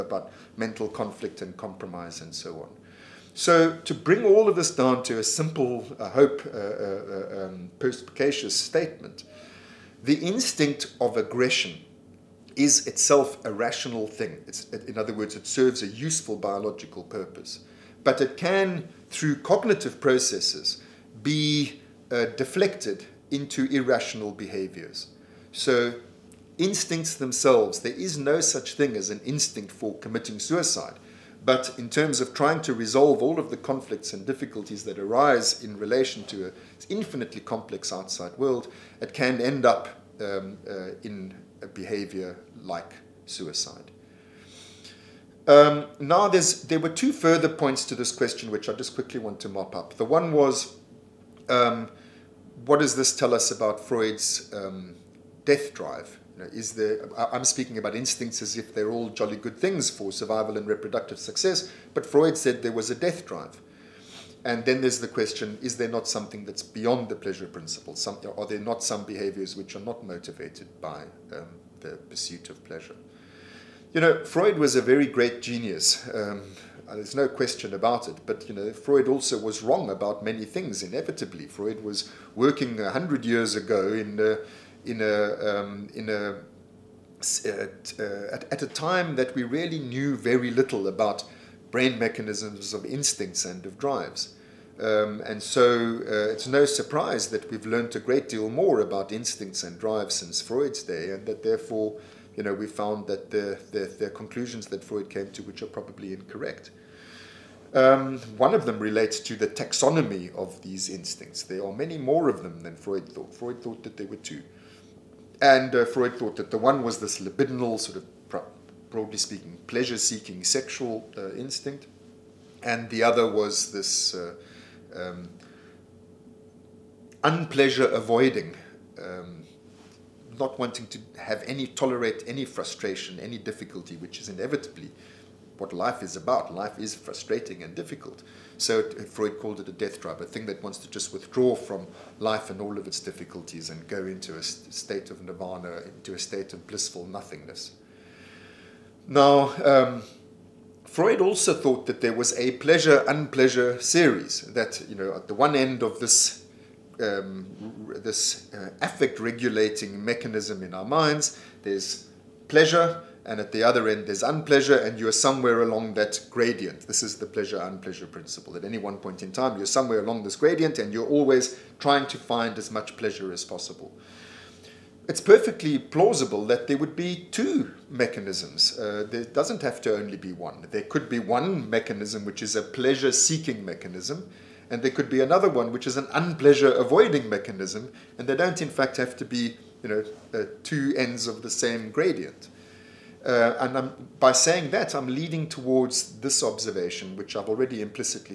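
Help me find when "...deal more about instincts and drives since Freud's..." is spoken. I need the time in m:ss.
1:38.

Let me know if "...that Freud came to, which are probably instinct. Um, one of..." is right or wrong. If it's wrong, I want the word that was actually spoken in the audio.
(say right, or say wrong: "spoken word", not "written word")
wrong: "incorrect", not "instinct".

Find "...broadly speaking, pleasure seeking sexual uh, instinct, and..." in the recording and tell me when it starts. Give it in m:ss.
1:58.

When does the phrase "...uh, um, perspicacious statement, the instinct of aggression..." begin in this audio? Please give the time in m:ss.
0:06.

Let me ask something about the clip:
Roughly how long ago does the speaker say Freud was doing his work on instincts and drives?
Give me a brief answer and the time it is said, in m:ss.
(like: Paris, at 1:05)
A hundred years ago, at 1:22.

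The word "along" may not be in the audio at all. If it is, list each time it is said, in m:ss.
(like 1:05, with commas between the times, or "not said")
2:45, 2:49.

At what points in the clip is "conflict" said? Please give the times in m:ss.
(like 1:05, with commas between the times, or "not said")
0:00, 0:33.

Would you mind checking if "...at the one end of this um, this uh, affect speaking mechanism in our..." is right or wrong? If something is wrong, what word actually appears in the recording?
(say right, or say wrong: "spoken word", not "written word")
wrong: "regulating", not "speaking".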